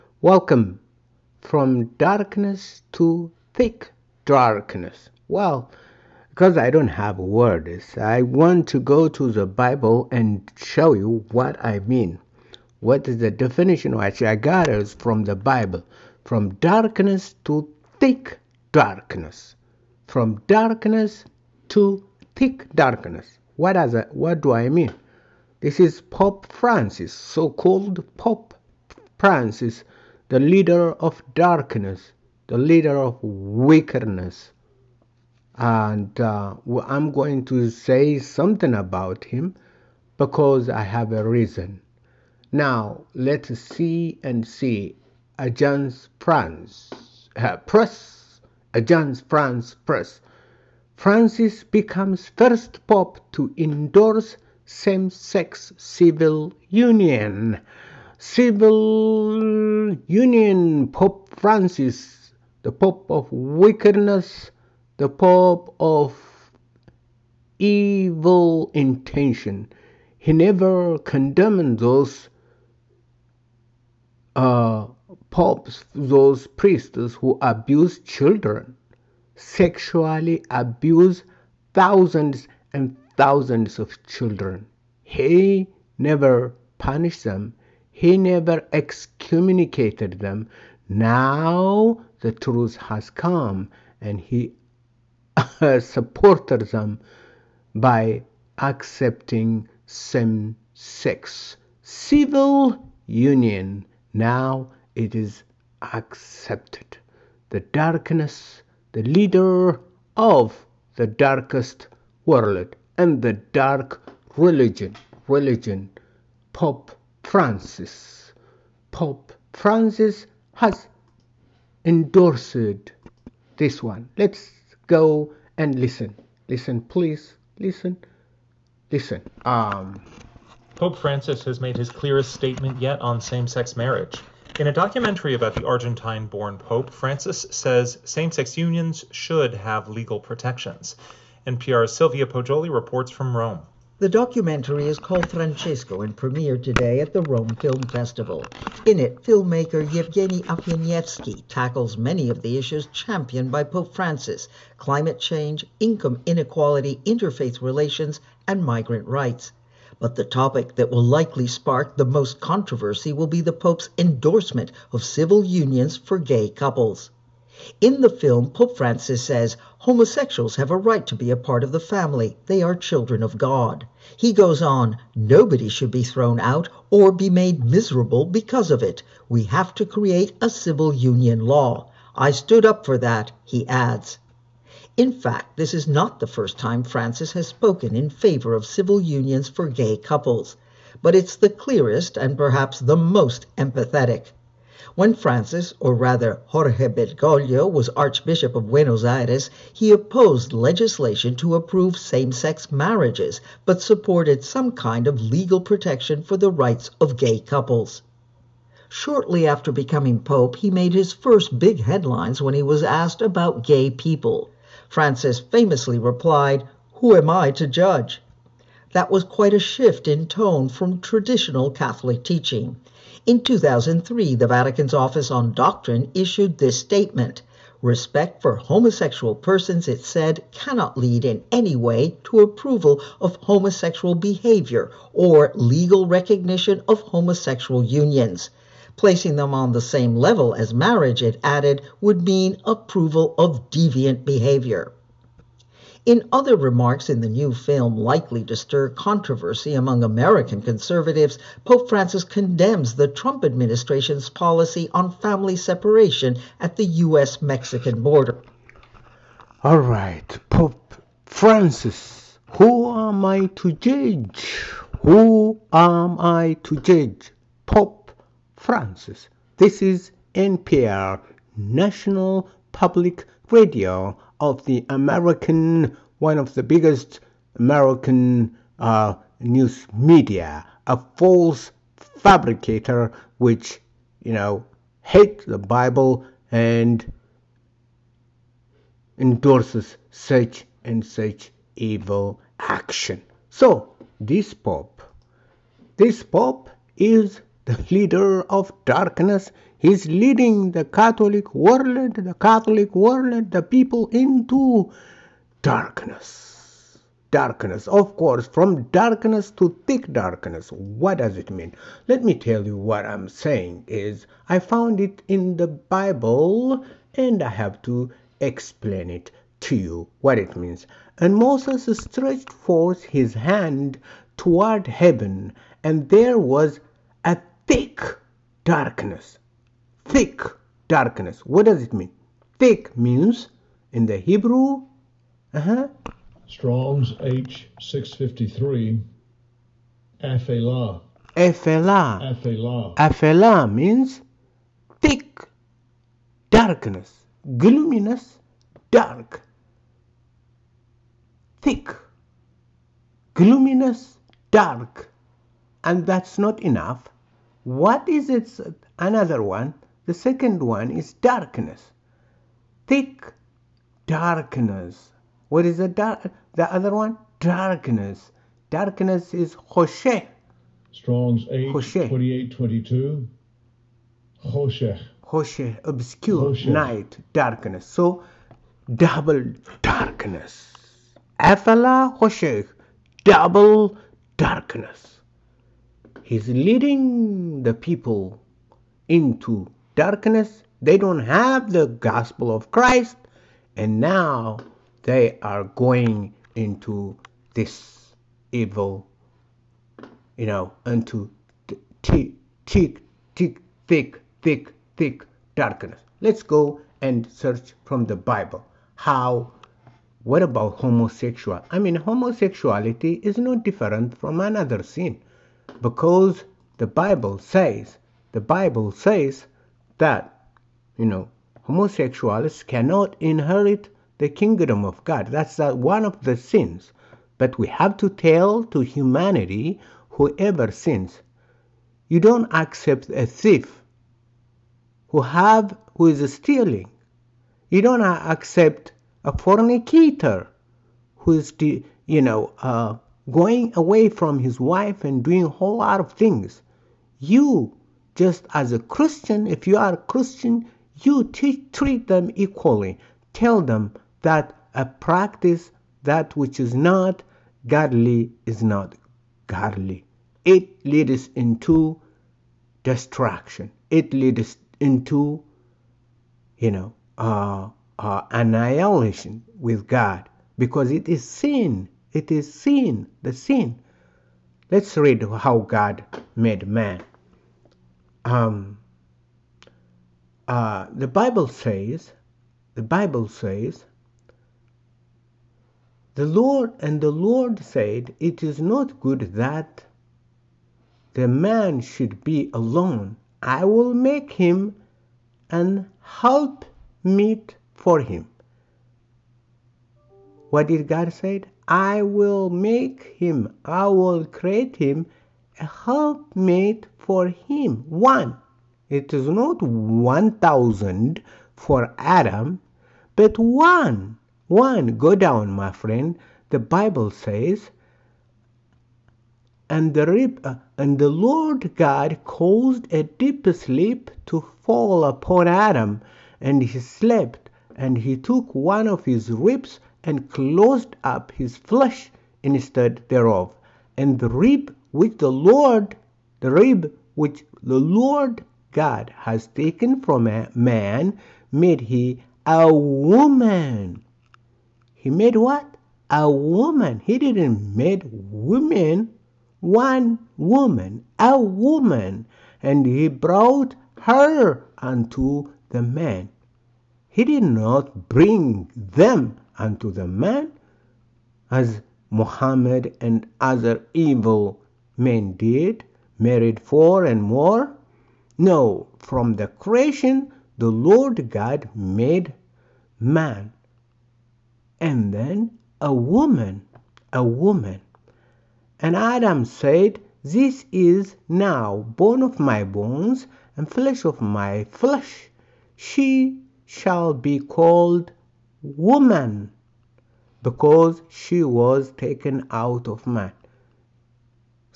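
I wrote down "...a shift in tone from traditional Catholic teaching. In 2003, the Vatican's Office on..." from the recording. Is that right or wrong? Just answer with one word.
right.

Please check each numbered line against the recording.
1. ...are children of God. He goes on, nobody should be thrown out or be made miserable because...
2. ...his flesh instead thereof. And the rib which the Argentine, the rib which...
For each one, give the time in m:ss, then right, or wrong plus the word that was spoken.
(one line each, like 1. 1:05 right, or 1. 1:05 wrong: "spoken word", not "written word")
1. 2:52 right
2. 8:51 wrong: "Lord", not "Argentine".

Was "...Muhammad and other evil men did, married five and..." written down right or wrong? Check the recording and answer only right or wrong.
wrong.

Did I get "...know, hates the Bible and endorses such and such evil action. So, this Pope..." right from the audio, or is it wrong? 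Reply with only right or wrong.
right.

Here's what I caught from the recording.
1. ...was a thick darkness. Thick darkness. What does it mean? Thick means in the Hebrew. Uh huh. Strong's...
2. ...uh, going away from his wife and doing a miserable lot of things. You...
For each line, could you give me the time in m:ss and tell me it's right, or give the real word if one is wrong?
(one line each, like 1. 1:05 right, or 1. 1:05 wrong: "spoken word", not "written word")
1. 5:26 right
2. 7:22 wrong: "whole", not "miserable".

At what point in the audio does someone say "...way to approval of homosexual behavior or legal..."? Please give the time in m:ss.
3:51.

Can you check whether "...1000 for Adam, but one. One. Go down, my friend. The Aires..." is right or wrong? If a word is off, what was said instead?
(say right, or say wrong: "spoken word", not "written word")
wrong: "Bible", not "Aires".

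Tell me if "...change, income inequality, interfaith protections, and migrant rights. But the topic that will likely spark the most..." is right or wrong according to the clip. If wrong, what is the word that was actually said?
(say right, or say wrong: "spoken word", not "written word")
wrong: "relations", not "protections".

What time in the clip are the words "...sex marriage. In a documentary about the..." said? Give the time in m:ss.
2:13.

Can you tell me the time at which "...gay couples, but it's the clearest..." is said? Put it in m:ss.
3:09.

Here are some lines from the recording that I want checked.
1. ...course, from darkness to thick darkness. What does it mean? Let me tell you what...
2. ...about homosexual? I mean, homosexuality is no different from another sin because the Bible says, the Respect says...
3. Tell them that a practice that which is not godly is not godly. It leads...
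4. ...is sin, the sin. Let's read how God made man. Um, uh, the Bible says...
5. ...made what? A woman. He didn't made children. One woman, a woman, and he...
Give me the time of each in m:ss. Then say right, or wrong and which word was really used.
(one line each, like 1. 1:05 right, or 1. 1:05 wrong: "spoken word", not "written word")
1. 5:08 right
2. 6:50 wrong: "Bible", not "Respect"
3. 7:33 right
4. 7:52 right
5. 9:05 wrong: "women", not "children".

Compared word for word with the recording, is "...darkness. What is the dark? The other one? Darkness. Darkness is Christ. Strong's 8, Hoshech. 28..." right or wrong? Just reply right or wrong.
wrong.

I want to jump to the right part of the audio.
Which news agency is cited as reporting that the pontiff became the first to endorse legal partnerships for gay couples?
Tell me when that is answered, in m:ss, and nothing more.
0:48.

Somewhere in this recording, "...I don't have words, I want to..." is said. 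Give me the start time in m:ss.
0:06.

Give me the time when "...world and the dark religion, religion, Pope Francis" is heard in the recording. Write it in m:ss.
1:52.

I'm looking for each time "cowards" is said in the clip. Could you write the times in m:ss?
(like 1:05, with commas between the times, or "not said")
not said.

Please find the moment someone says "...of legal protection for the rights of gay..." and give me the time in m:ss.
3:25.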